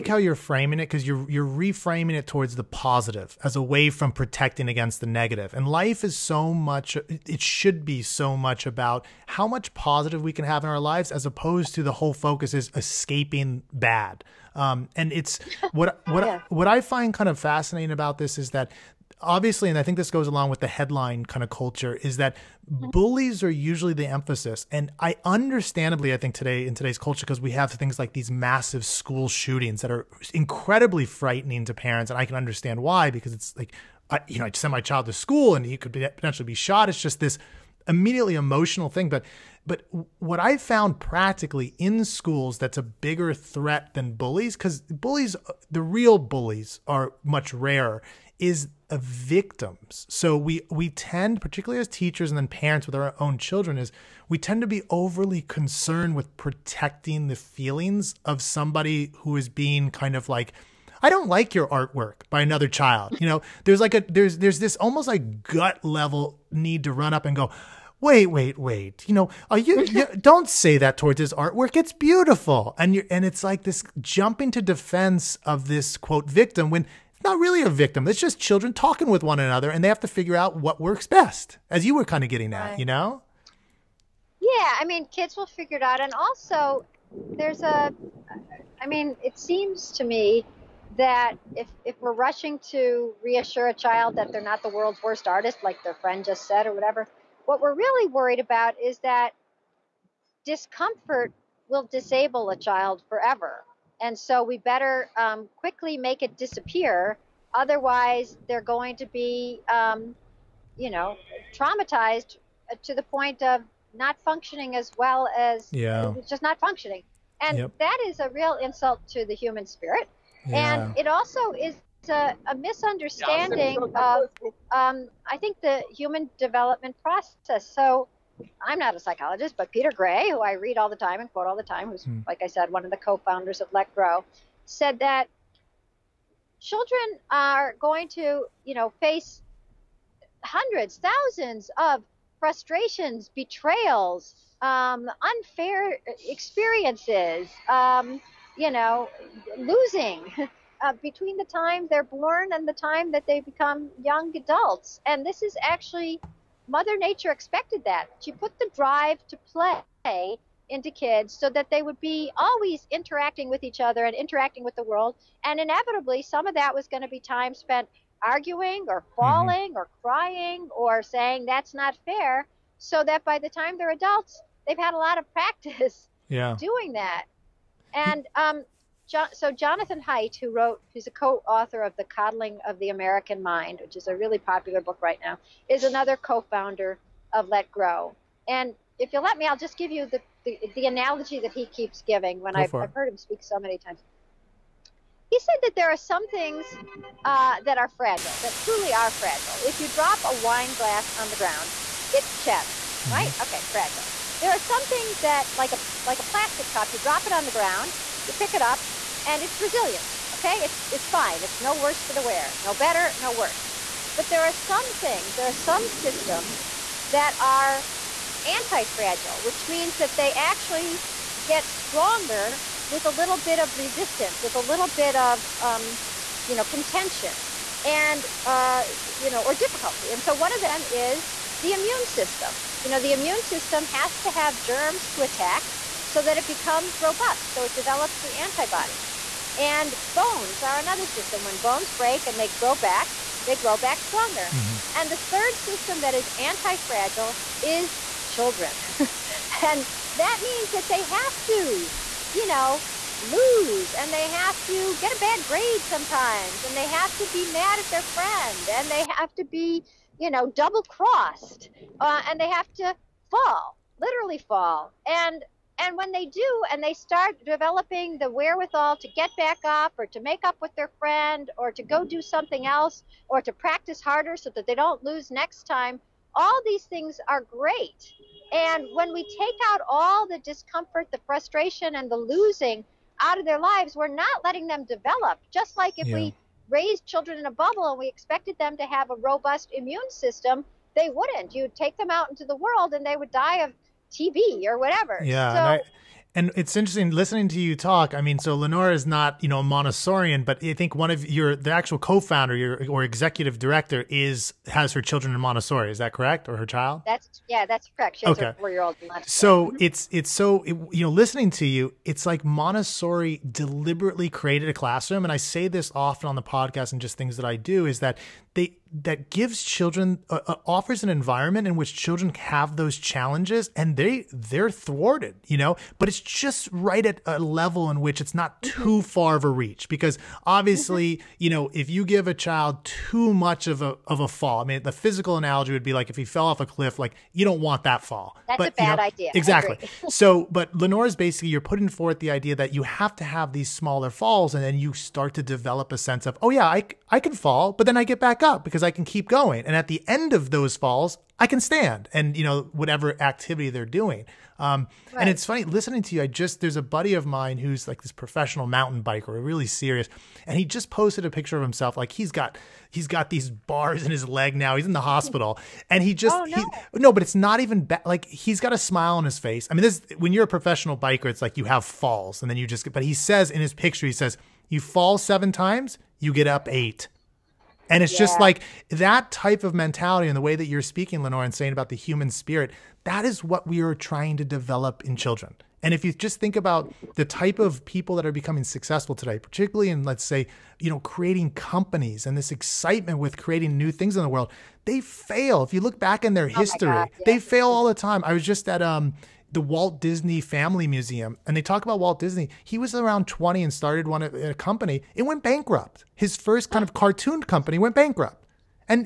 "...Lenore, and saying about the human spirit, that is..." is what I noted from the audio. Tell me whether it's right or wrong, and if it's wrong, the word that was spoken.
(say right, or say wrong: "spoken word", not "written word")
right.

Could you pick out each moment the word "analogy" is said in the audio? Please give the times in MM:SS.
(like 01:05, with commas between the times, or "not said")
03:10, 05:35.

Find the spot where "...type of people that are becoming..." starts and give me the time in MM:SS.
06:27.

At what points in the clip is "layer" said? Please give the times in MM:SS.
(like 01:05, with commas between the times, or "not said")
not said.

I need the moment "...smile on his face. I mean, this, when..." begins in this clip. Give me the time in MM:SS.
06:08.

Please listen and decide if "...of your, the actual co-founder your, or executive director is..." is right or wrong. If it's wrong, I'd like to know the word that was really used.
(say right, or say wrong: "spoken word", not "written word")
right.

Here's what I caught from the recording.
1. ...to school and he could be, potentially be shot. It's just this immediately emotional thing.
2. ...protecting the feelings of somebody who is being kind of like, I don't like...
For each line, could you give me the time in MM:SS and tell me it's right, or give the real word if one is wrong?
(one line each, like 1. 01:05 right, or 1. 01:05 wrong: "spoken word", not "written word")
1. 00:35 right
2. 00:56 right.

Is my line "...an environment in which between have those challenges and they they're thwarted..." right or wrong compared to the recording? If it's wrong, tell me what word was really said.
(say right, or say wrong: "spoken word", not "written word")
wrong: "children", not "between".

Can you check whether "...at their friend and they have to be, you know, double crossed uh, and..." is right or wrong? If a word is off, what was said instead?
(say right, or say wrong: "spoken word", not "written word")
right.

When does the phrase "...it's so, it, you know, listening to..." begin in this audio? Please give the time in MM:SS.
05:10.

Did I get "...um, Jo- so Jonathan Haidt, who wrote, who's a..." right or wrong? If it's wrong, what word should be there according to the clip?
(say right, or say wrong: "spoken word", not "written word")
right.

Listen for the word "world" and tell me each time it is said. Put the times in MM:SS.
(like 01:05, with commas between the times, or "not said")
01:34, 02:44, 04:52, 06:34.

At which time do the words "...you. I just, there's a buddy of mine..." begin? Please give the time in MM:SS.
05:56.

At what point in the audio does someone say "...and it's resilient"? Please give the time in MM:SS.
03:29.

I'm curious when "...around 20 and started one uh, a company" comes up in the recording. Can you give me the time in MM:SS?
06:42.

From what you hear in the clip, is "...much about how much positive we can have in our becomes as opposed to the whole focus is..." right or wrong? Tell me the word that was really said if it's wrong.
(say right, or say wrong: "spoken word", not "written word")
wrong: "lives", not "becomes".